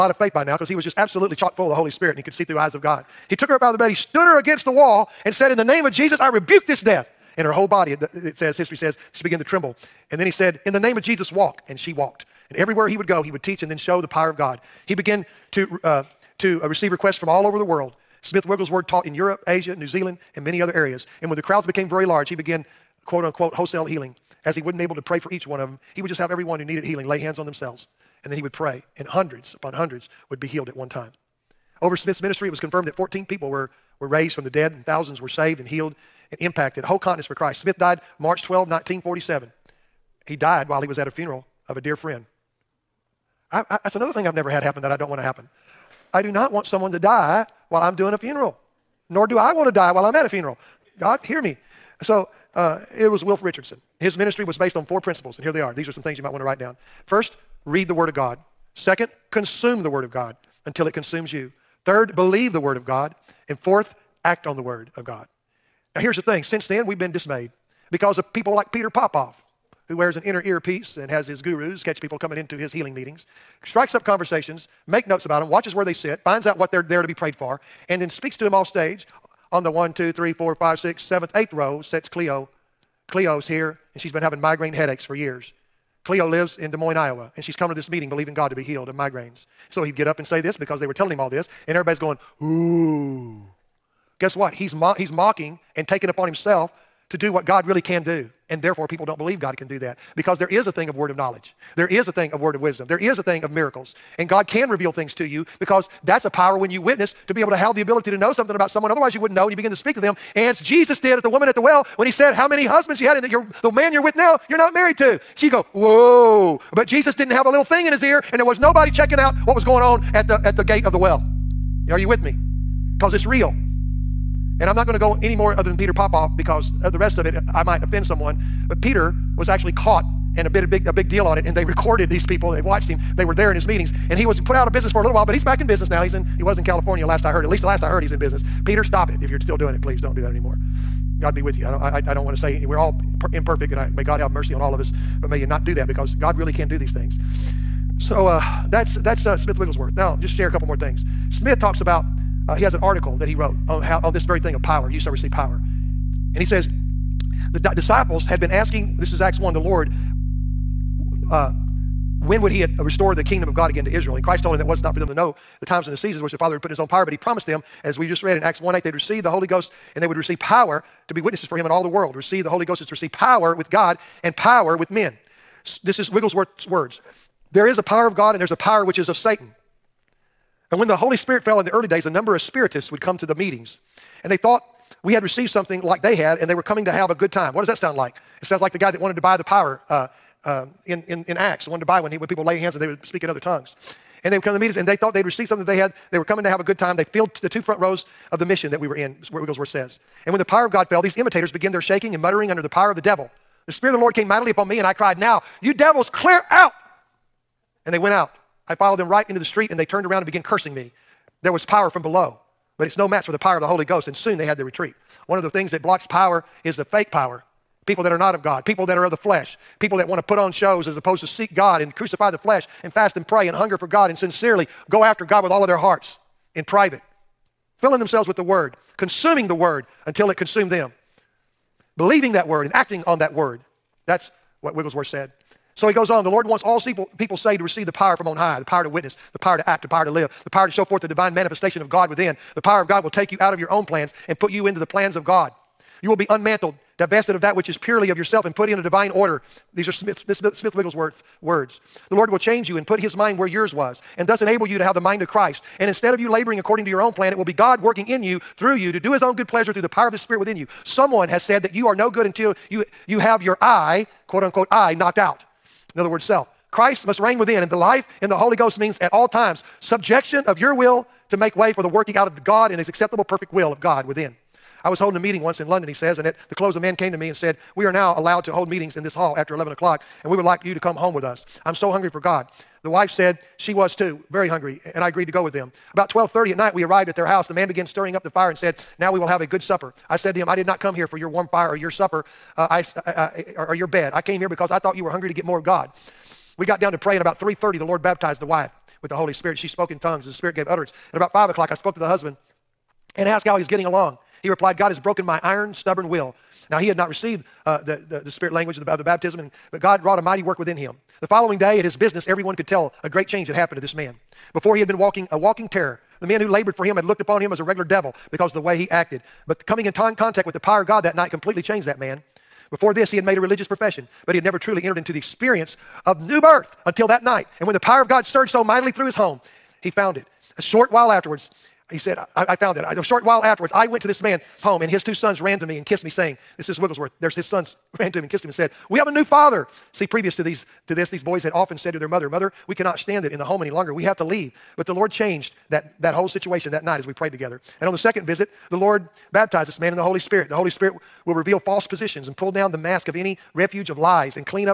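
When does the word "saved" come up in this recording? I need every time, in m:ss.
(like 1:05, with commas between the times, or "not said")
0:35, 3:57.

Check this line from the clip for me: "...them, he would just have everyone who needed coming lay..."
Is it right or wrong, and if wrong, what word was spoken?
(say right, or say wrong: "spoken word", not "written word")
wrong: "healing", not "coming".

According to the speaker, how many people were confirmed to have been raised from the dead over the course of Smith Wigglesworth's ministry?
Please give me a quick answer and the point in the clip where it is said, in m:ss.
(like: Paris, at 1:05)
14, at 0:32.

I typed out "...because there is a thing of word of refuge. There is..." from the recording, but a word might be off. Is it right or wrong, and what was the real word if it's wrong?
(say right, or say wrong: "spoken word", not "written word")
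wrong: "knowledge", not "refuge".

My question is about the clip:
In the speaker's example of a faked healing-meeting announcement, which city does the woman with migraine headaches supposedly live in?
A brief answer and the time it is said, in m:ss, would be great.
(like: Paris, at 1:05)
Des Moines, Iowa, at 1:26.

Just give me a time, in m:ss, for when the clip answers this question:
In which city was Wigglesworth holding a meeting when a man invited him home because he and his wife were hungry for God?
4:35.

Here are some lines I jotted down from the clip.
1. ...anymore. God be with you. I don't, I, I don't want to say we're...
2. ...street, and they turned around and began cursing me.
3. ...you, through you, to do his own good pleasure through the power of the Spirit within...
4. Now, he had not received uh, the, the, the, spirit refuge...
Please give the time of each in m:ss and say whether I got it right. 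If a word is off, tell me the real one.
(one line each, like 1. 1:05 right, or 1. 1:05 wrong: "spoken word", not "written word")
1. 2:20 right
2. 3:29 right
3. 4:18 right
4. 5:06 wrong: "language", not "refuge".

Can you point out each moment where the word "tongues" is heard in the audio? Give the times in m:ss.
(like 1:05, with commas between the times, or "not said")
3:13, 4:59.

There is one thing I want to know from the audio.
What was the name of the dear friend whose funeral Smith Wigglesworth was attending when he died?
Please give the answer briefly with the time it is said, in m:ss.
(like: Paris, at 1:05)
Wilf Richardson, at 0:53.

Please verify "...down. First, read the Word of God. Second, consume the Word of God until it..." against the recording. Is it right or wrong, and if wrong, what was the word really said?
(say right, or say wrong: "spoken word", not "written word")
right.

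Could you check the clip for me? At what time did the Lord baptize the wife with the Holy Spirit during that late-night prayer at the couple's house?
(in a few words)
3:30.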